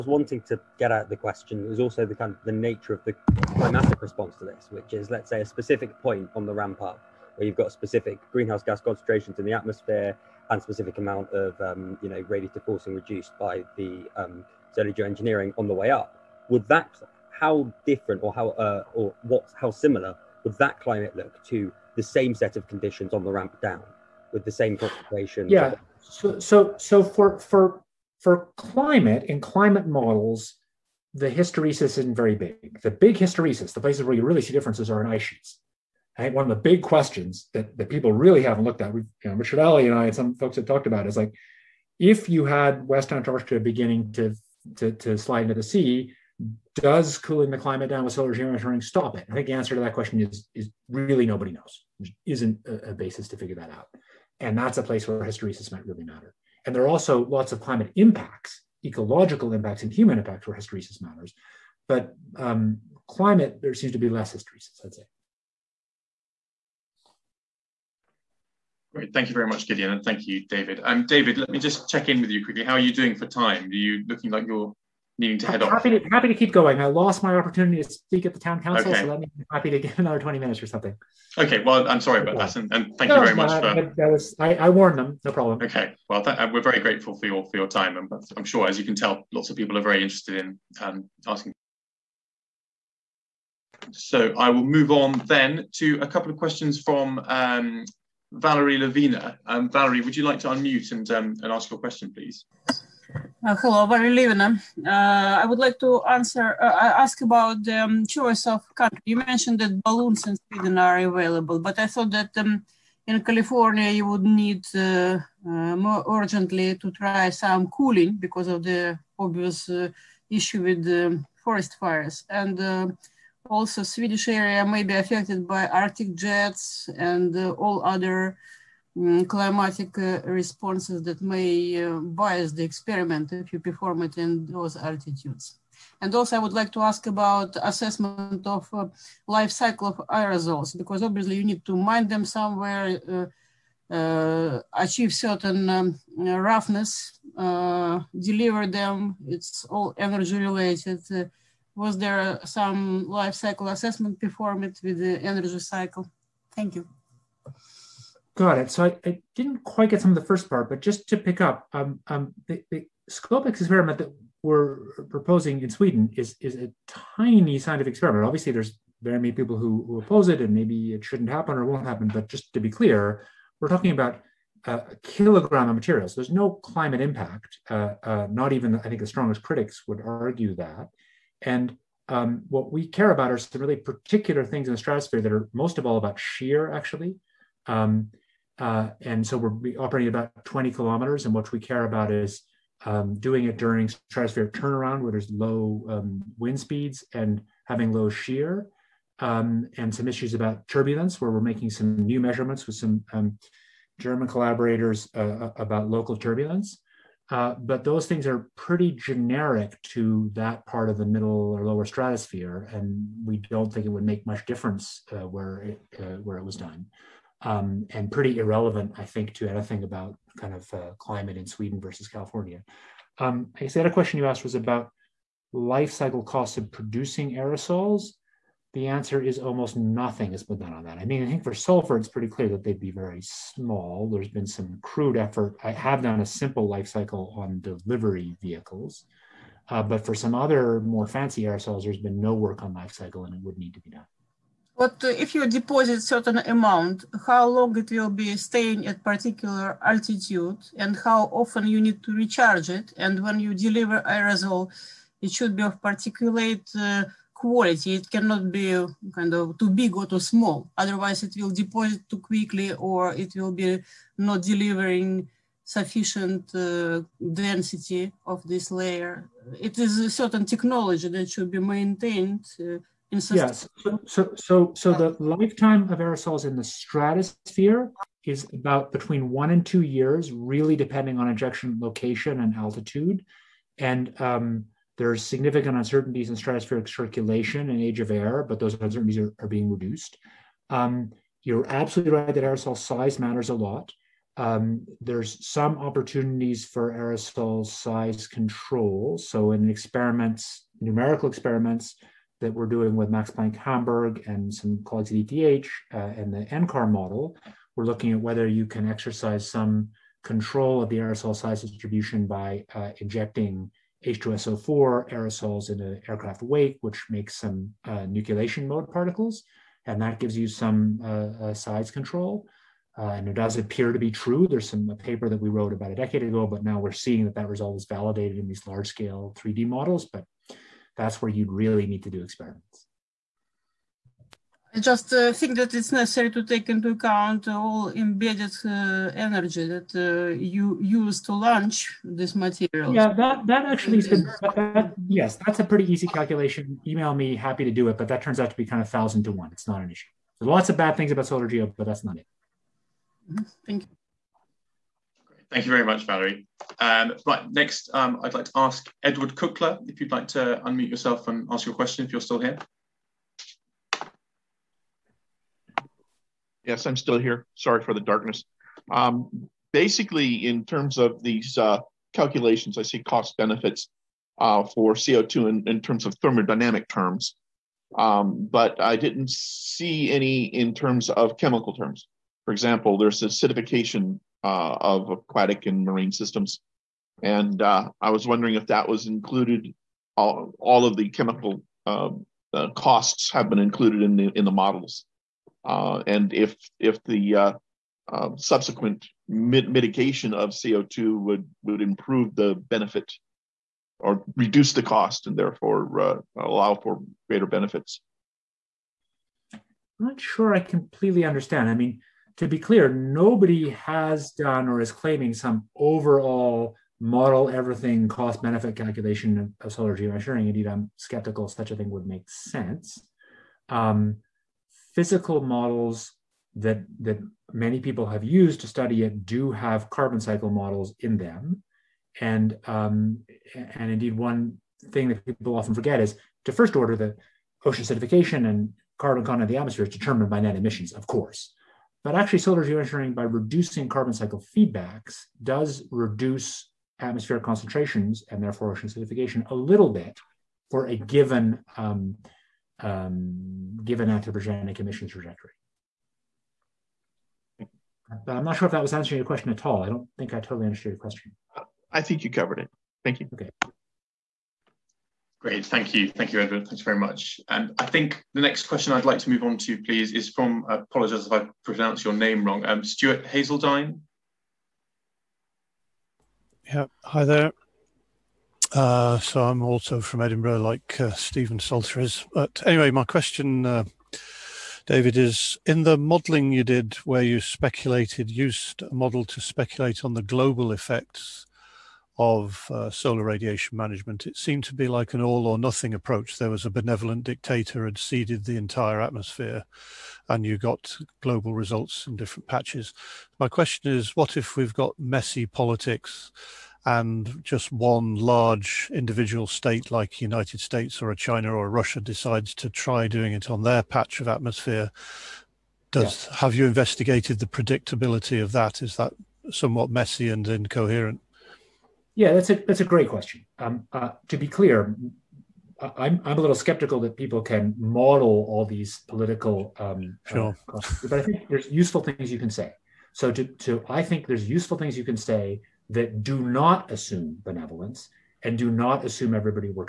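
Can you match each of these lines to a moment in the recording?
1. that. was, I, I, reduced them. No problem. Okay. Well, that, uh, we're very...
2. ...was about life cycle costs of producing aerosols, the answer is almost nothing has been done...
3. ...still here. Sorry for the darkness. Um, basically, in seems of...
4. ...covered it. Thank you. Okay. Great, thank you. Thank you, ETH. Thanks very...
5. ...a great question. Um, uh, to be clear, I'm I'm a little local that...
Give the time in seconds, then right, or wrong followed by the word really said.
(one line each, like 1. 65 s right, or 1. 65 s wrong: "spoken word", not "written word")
1. 83 s wrong: "warned", not "reduced"
2. 224 s right
3. 366 s wrong: "terms", not "seems"
4. 462 s wrong: "Edward", not "ETH"
5. 522 s wrong: "skeptical", not "local".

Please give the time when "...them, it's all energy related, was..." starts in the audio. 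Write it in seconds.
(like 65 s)
148 s.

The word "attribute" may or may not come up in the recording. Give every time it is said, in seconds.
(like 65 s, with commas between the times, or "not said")
not said.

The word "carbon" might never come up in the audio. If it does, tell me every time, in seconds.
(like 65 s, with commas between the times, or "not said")
429 s, 438 s, 443 s.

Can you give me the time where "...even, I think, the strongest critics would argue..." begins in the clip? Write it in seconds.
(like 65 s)
178 s.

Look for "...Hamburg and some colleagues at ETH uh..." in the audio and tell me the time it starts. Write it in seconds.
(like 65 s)
303 s.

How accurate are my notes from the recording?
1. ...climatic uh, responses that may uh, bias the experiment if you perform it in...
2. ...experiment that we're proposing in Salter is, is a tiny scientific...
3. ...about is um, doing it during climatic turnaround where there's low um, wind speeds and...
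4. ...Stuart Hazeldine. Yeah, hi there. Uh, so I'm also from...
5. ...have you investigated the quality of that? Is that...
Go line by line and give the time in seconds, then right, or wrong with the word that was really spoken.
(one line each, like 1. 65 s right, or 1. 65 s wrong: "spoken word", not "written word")
1. 129 s right
2. 163 s wrong: "Sweden", not "Salter"
3. 191 s wrong: "stratospheric", not "climatic"
4. 472 s right
5. 516 s wrong: "predictability", not "quality".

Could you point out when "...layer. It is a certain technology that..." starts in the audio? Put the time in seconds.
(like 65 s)
268 s.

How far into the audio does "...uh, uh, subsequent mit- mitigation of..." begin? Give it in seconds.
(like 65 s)
397 s.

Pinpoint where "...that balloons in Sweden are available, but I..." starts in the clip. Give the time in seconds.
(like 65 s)
109 s.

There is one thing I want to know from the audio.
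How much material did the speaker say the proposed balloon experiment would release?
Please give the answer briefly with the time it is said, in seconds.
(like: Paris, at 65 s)
a kilogram, at 174 s.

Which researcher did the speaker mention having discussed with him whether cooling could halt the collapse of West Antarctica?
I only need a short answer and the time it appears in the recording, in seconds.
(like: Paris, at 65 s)
Richard Alley, at 39 s.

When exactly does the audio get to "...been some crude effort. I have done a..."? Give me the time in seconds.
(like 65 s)
234 s.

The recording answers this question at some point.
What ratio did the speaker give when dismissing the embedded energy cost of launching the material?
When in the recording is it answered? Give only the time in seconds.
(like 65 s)
348 s.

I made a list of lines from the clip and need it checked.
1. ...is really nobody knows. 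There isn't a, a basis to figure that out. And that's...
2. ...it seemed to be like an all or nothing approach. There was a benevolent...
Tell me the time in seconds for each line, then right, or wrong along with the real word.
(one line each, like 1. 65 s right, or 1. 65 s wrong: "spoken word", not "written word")
1. 50 s right
2. 494 s right.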